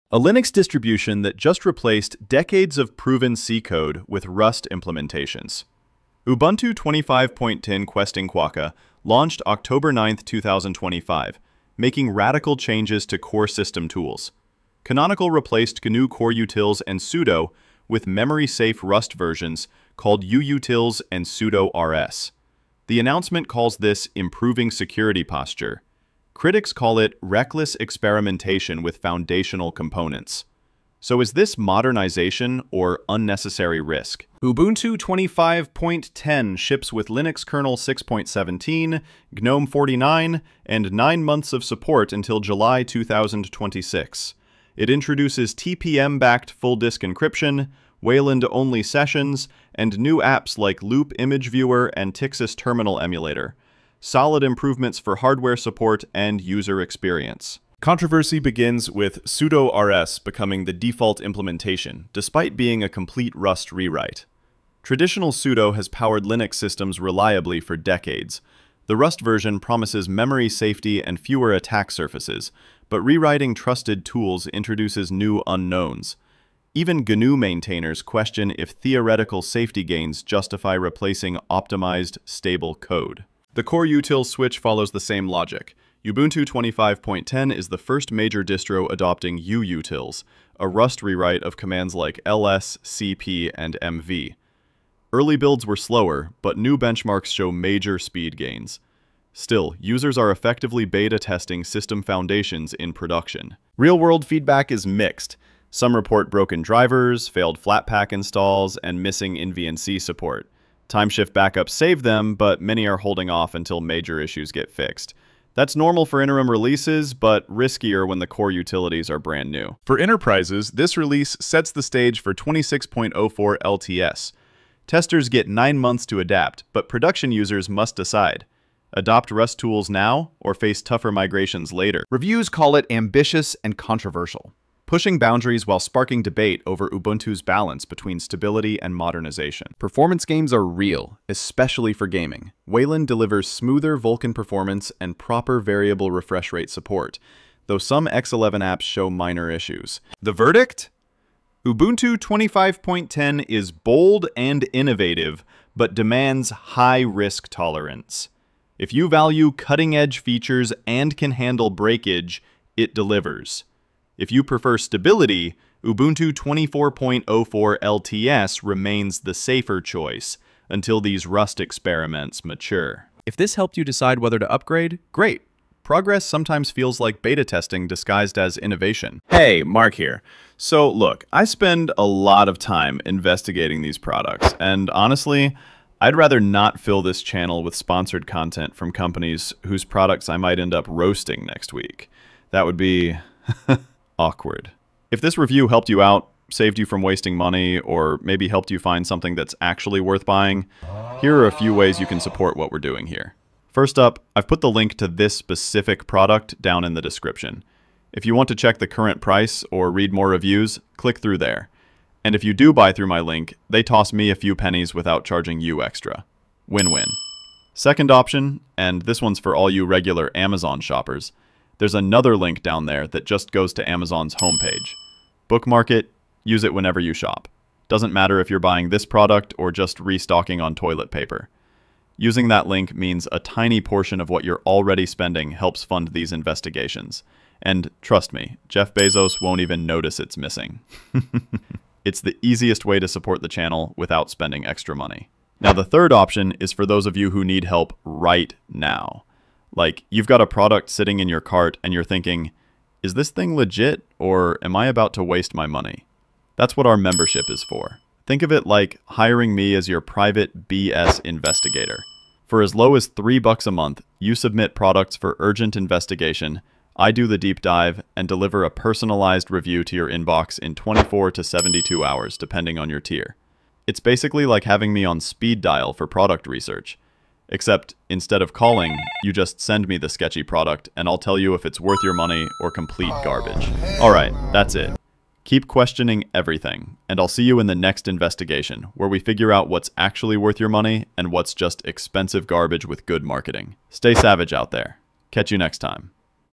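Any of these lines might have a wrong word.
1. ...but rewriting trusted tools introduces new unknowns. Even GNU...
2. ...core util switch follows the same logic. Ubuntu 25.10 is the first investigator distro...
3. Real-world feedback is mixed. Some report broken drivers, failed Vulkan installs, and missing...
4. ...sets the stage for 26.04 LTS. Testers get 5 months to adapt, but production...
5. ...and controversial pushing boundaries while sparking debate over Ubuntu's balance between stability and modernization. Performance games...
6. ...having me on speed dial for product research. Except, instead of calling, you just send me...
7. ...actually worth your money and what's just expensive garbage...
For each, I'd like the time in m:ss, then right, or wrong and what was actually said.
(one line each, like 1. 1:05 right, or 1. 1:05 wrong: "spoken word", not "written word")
1. 1:12 right
2. 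1:23 wrong: "major", not "investigator"
3. 1:43 wrong: "Flatpak", not "Vulkan"
4. 2:01 wrong: "9", not "5"
5. 2:13 right
6. 4:34 right
7. 4:49 right.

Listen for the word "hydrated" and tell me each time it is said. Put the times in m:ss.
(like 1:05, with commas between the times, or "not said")
not said.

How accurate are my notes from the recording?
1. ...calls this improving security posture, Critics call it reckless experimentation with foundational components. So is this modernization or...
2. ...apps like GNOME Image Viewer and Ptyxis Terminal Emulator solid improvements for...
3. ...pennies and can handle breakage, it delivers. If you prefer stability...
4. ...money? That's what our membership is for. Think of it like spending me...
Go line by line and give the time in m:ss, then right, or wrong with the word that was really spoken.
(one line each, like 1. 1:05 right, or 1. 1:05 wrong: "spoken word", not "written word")
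1. 0:23 right
2. 0:50 wrong: "Loupe", not "GNOME"
3. 2:40 wrong: "features", not "pennies"
4. 4:15 wrong: "hiring", not "spending".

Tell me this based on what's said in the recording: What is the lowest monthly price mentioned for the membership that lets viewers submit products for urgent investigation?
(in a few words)
$3.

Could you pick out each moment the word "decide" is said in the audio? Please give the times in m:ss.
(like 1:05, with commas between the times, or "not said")
2:07, 2:53.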